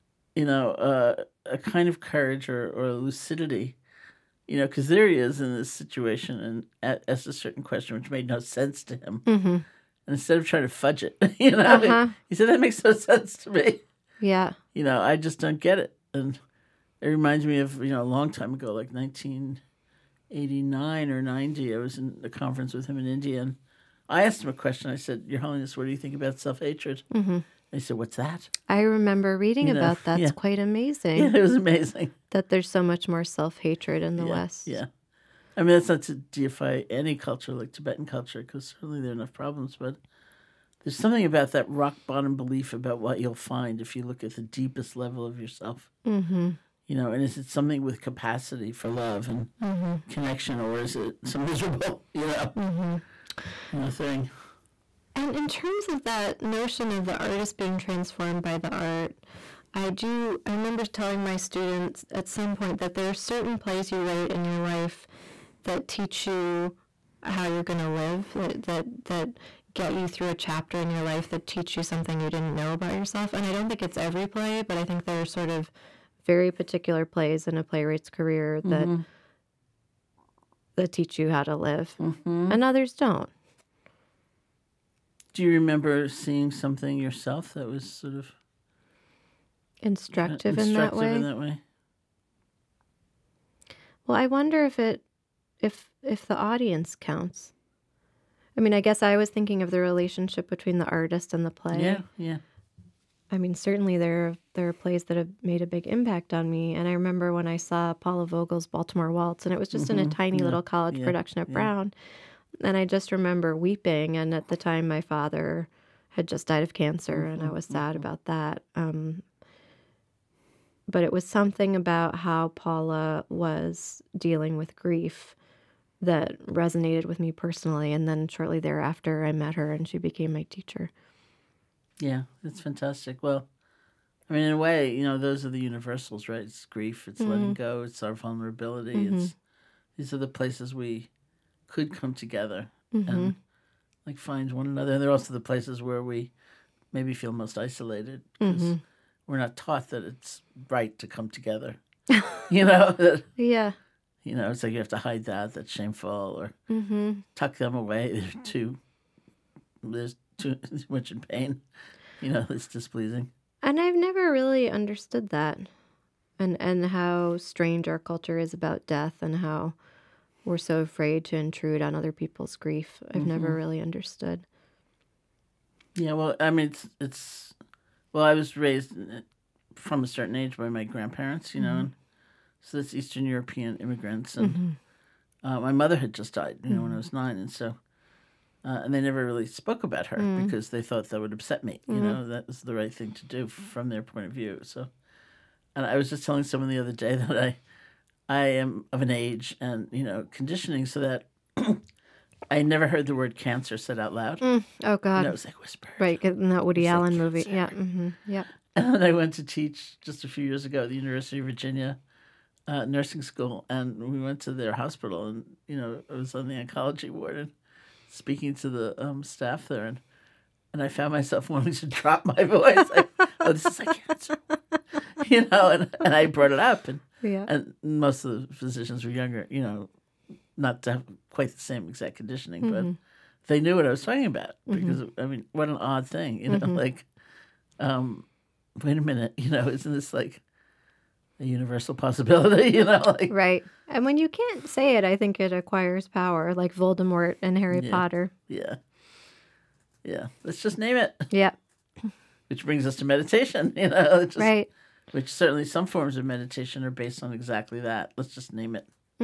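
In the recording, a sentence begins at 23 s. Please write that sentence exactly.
And I asked him a question.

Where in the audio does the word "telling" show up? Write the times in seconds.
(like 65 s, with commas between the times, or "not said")
60 s, 196 s.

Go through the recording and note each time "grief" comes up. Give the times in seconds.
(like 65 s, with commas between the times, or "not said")
124 s, 136 s, 172 s.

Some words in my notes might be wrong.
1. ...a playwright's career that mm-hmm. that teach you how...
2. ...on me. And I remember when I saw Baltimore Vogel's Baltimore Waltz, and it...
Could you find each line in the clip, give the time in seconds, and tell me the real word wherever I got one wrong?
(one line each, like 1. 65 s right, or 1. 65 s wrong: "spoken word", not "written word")
1. 77 s right
2. 106 s wrong: "Paula", not "Baltimore".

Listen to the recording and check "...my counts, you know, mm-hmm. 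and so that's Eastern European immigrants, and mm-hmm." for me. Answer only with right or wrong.
wrong.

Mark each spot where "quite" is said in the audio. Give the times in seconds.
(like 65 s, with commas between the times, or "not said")
30 s, 231 s.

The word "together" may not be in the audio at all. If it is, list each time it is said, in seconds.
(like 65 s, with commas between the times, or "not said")
142 s, 151 s.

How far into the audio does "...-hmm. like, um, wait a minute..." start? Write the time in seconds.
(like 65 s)
236 s.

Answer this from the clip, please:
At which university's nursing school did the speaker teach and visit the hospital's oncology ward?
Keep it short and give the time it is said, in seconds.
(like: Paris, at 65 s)
University of Virginia, at 210 s.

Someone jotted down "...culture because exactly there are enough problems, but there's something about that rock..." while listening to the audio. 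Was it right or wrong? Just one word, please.
wrong.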